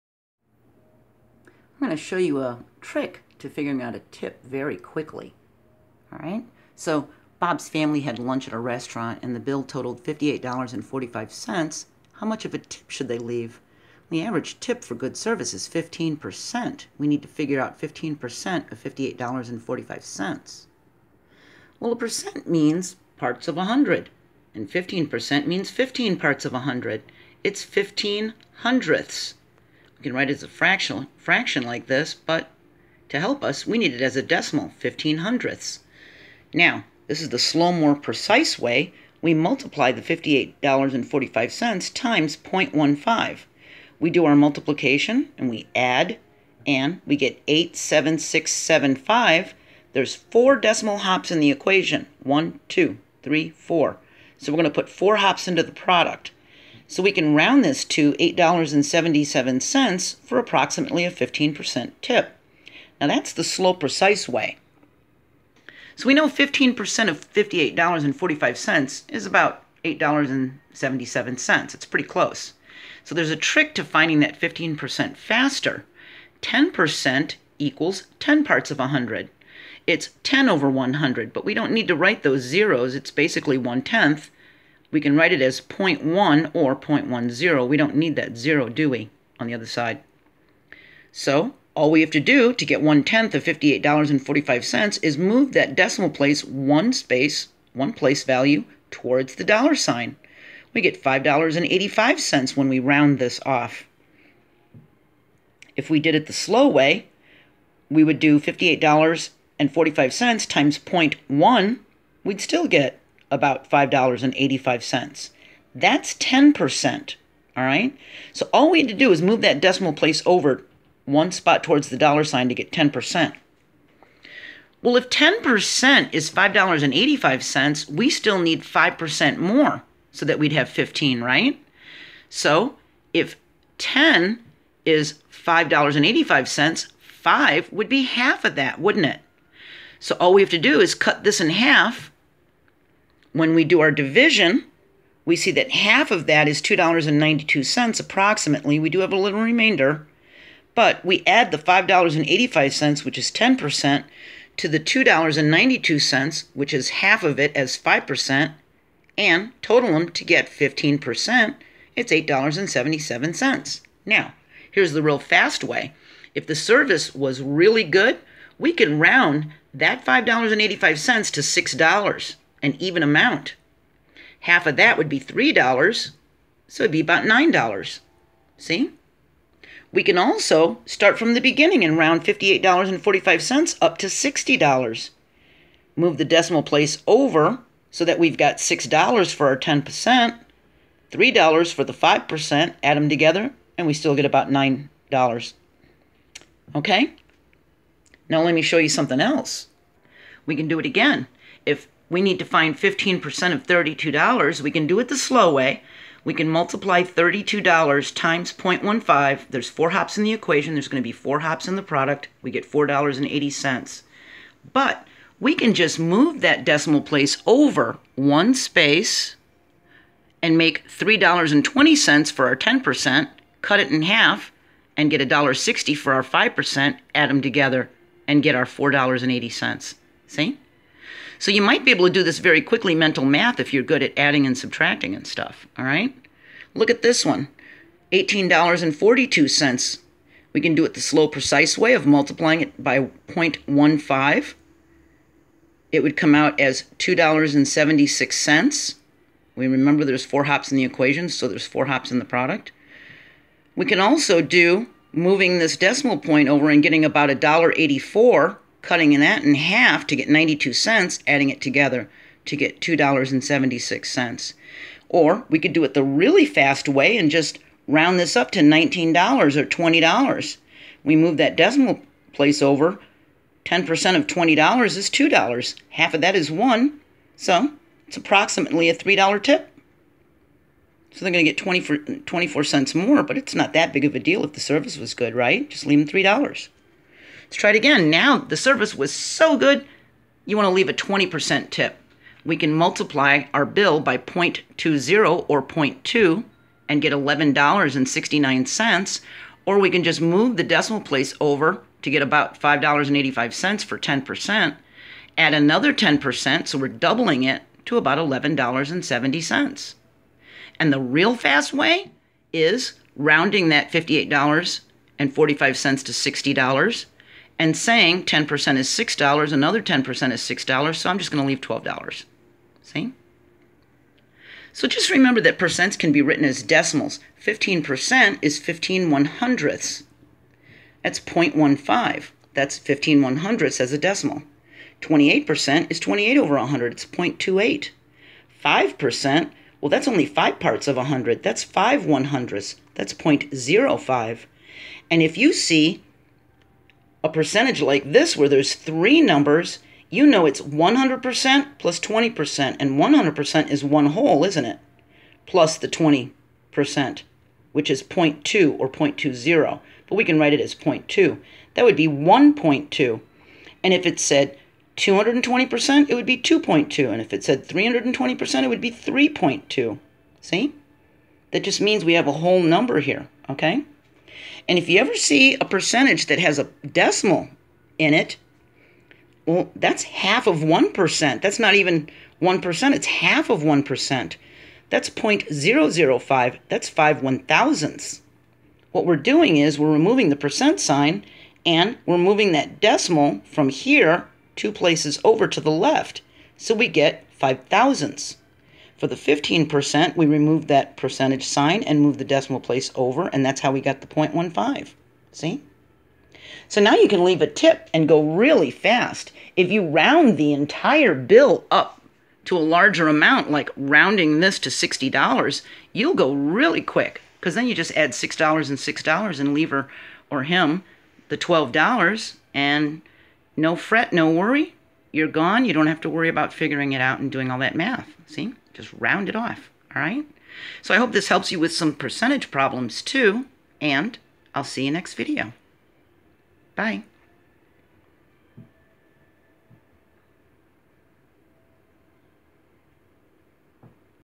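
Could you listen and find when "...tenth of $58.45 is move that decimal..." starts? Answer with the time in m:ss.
1:33.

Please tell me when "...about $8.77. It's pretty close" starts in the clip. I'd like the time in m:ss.
1:09.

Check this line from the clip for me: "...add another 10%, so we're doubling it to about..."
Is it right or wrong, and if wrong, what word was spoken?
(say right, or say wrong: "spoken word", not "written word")
right.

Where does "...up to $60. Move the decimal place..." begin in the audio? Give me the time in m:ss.
3:03.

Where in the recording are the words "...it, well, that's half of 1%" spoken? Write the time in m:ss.
6:18.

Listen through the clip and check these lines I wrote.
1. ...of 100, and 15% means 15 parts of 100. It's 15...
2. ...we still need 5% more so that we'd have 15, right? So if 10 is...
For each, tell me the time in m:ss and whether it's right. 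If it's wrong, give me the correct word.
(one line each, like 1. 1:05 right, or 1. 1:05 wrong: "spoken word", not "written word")
1. 0:23 right
2. 2:07 right.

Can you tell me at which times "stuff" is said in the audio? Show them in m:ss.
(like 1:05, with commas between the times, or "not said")
3:55.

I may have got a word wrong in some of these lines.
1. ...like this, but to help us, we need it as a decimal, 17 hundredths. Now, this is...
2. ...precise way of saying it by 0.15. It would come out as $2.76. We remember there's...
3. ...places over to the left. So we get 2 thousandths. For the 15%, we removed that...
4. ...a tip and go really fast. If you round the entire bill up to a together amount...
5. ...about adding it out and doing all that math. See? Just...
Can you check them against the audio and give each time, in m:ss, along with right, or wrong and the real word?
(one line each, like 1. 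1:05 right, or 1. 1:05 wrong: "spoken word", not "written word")
1. 0:31 wrong: "15", not "17"
2. 4:01 wrong: "multiplying", not "saying"
3. 6:34 wrong: "5", not "2"
4. 6:47 wrong: "larger", not "together"
5. 7:06 wrong: "figuring", not "adding".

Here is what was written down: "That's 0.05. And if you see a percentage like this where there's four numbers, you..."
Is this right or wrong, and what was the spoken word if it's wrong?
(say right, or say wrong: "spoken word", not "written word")
wrong: "three", not "four".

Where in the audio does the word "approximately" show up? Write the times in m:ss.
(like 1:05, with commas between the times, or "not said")
1:00, 4:38.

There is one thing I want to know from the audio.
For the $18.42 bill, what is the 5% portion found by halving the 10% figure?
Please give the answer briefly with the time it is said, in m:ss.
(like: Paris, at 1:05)
92 cents, at 4:20.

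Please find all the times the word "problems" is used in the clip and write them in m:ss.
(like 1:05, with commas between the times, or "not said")
7:12.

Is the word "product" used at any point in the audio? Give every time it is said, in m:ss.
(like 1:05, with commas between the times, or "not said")
0:55, 3:31, 4:12.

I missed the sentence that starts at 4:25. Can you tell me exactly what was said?
Or we could do it the really fast way and just round this up to $19 or $20.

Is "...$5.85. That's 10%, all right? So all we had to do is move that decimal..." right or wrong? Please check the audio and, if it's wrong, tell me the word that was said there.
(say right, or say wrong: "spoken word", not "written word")
right.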